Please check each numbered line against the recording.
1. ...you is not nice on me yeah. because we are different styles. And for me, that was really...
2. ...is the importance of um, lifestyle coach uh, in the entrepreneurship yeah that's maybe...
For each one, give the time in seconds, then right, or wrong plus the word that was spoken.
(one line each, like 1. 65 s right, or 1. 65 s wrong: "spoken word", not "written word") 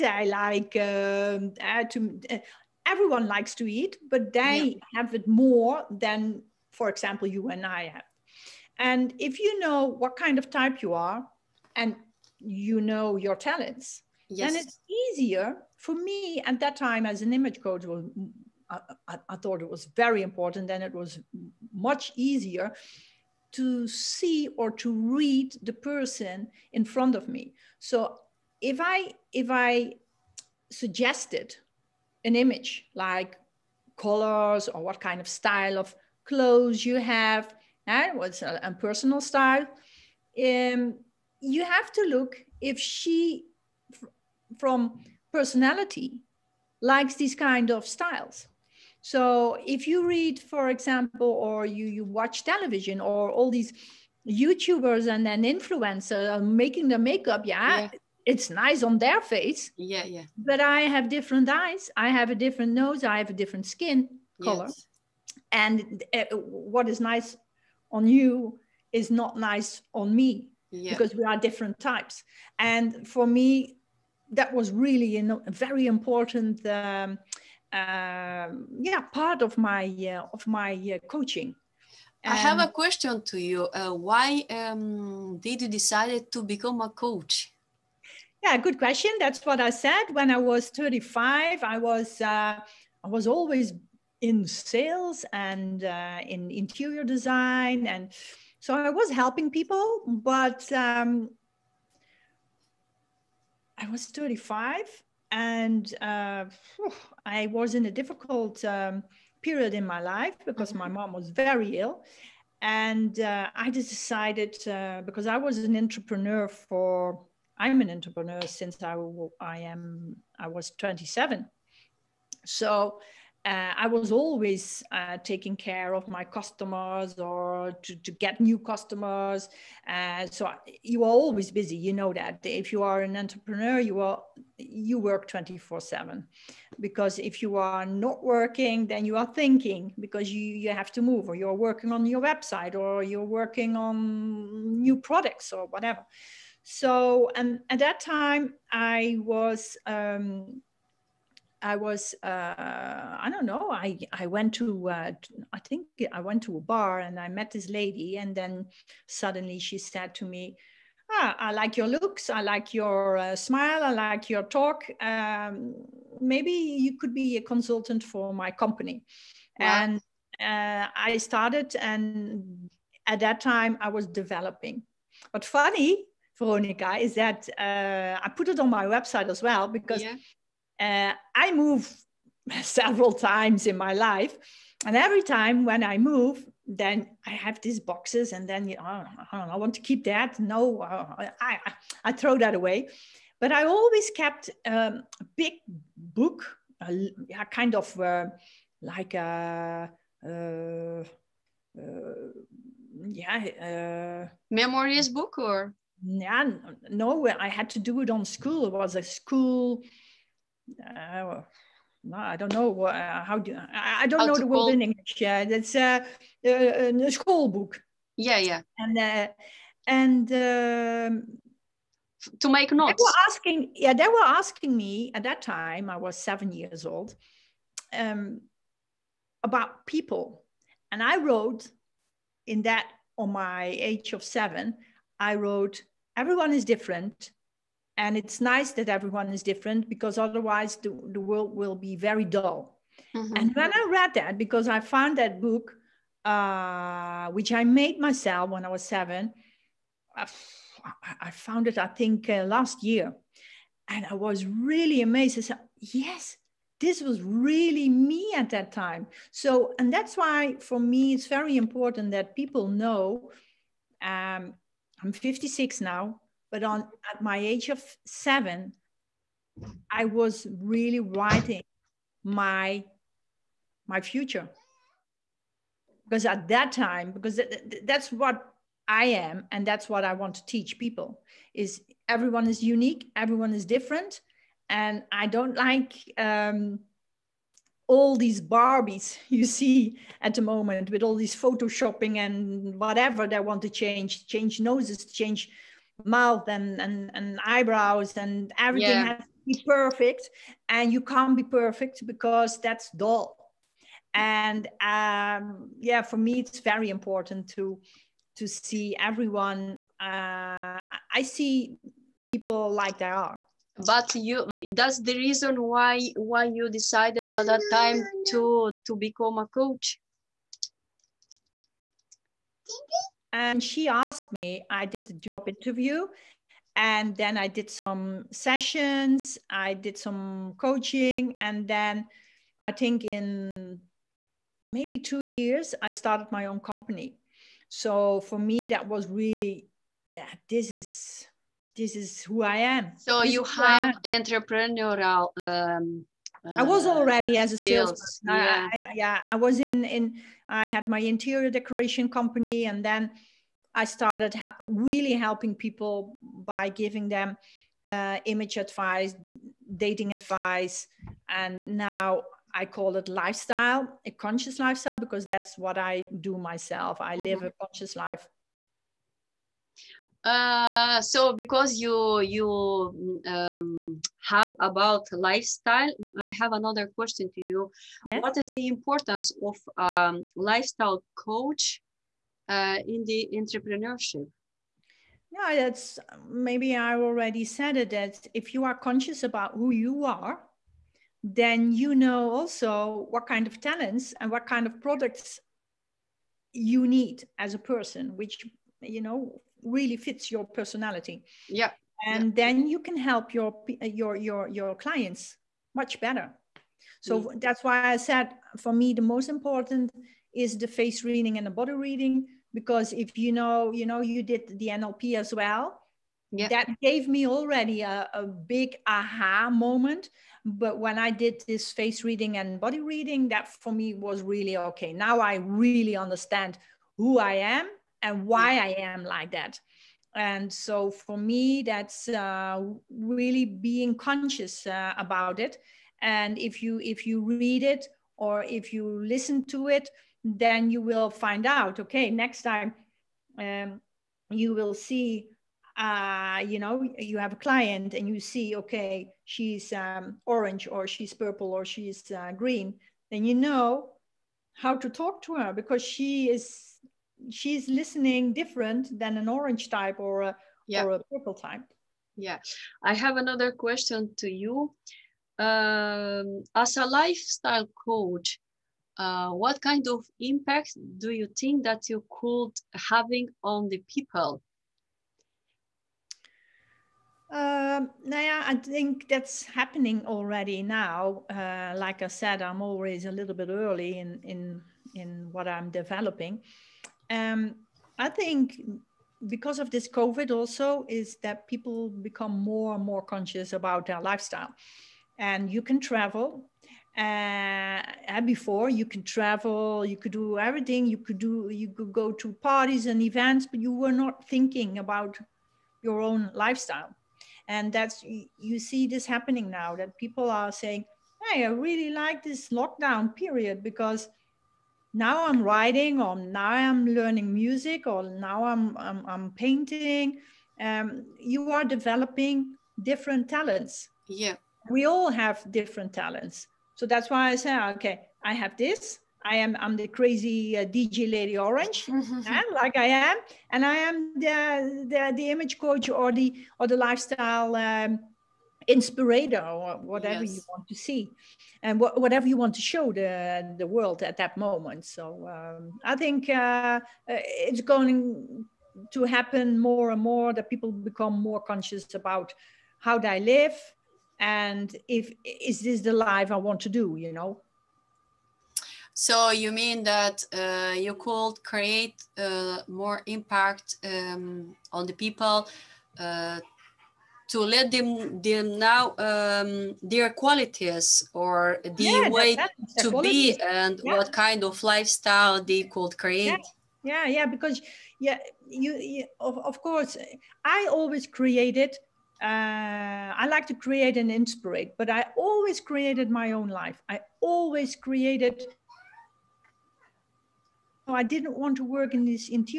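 1. 68 s wrong: "types", not "styles"
2. 378 s right.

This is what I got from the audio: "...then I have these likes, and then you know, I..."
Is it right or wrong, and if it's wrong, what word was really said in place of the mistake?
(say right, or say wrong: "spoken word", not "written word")
wrong: "boxes", not "likes".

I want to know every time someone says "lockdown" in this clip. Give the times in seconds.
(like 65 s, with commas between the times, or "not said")
512 s.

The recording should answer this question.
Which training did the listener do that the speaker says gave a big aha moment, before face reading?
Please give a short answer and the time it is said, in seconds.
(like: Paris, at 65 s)
NLP, at 414 s.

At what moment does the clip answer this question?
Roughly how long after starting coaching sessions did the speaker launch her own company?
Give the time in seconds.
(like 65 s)
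334 s.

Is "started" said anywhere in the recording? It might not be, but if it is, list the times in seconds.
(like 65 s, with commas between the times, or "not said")
171 s, 335 s, 353 s.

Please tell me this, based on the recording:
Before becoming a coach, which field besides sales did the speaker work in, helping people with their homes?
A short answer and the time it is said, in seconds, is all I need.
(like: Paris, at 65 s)
Interior design, at 96 s.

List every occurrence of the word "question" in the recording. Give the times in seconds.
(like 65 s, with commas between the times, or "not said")
82 s, 88 s, 376 s, 463 s.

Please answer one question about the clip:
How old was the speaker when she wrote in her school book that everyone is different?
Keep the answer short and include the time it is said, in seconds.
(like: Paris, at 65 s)
7, at 226 s.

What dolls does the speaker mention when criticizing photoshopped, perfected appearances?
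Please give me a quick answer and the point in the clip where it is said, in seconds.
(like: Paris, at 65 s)
Barbies, at 288 s.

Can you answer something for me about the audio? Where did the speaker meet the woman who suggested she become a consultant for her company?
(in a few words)
A bar.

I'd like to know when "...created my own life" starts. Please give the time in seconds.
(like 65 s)
585 s.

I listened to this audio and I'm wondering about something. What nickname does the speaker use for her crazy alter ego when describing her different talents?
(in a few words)
DJ Lady Orange.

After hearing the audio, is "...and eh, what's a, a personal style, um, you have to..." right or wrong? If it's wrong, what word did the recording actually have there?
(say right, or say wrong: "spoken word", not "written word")
right.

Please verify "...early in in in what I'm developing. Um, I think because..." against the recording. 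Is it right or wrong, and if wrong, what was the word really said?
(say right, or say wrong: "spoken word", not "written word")
right.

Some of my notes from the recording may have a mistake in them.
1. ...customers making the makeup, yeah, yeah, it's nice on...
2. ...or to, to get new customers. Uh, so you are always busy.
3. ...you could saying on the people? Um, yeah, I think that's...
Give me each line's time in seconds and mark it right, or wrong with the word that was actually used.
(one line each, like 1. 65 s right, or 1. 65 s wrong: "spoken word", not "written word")
1. 55 s wrong: "influencers", not "customers"
2. 127 s right
3. 471 s wrong: "having", not "saying".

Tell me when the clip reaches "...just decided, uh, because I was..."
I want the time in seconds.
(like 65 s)
113 s.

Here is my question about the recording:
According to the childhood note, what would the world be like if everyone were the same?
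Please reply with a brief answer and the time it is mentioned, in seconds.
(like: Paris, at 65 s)
Very dull, at 241 s.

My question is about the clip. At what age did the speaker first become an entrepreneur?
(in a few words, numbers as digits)
27.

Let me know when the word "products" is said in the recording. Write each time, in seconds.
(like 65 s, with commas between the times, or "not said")
144 s, 394 s.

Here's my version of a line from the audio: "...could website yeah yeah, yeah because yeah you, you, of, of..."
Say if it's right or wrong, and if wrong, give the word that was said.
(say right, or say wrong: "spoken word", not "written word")
wrong: "create", not "website".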